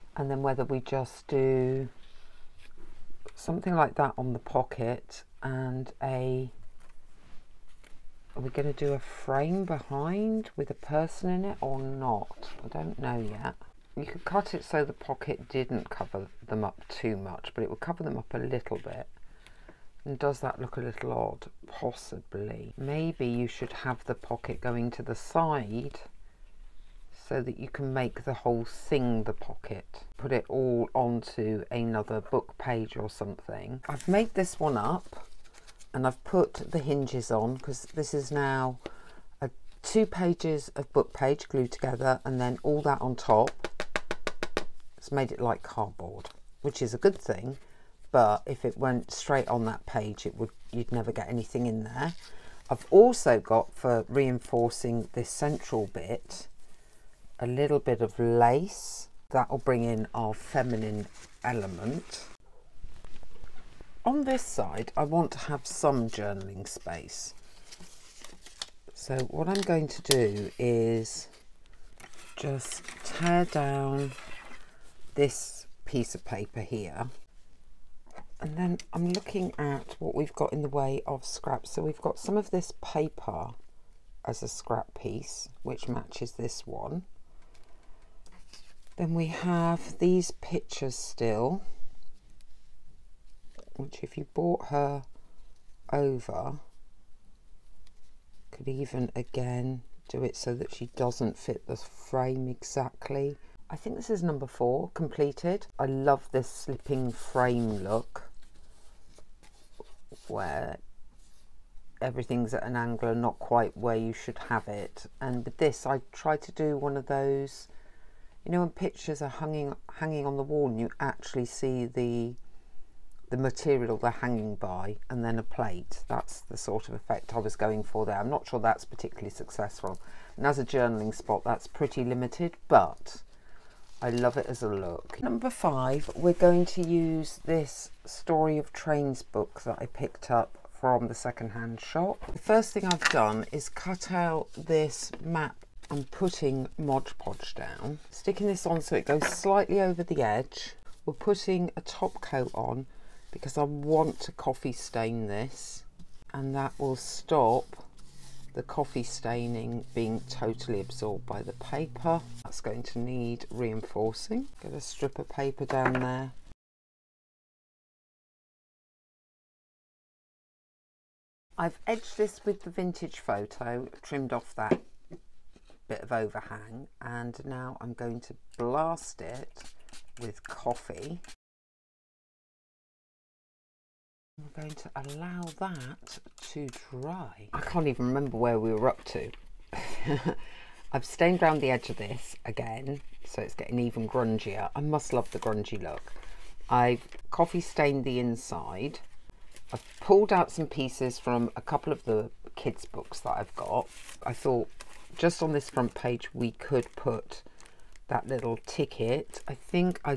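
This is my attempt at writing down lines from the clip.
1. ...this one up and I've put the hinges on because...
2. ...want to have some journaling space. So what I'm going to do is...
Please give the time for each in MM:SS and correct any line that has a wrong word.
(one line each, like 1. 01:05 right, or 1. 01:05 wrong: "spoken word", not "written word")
1. 00:34 right
2. 01:05 right.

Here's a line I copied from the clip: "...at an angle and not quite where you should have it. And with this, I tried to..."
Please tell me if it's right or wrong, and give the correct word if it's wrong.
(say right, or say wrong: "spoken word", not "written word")
right.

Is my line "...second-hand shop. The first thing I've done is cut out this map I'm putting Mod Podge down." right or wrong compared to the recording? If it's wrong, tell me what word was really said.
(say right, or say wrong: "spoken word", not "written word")
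right.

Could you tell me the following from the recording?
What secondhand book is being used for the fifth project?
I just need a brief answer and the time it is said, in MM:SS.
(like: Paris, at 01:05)
story of trains, at 02:18.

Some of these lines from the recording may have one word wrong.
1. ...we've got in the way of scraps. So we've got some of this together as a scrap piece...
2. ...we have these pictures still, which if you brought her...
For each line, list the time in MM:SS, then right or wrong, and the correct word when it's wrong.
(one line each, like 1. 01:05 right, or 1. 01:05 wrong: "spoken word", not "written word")
1. 01:20 wrong: "paper", not "together"
2. 01:29 right.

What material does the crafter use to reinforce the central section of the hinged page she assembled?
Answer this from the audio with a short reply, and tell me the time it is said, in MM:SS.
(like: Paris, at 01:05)
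lace, at 00:57.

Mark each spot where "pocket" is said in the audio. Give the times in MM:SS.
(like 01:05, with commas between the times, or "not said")
00:04, 00:14, 00:24, 00:29.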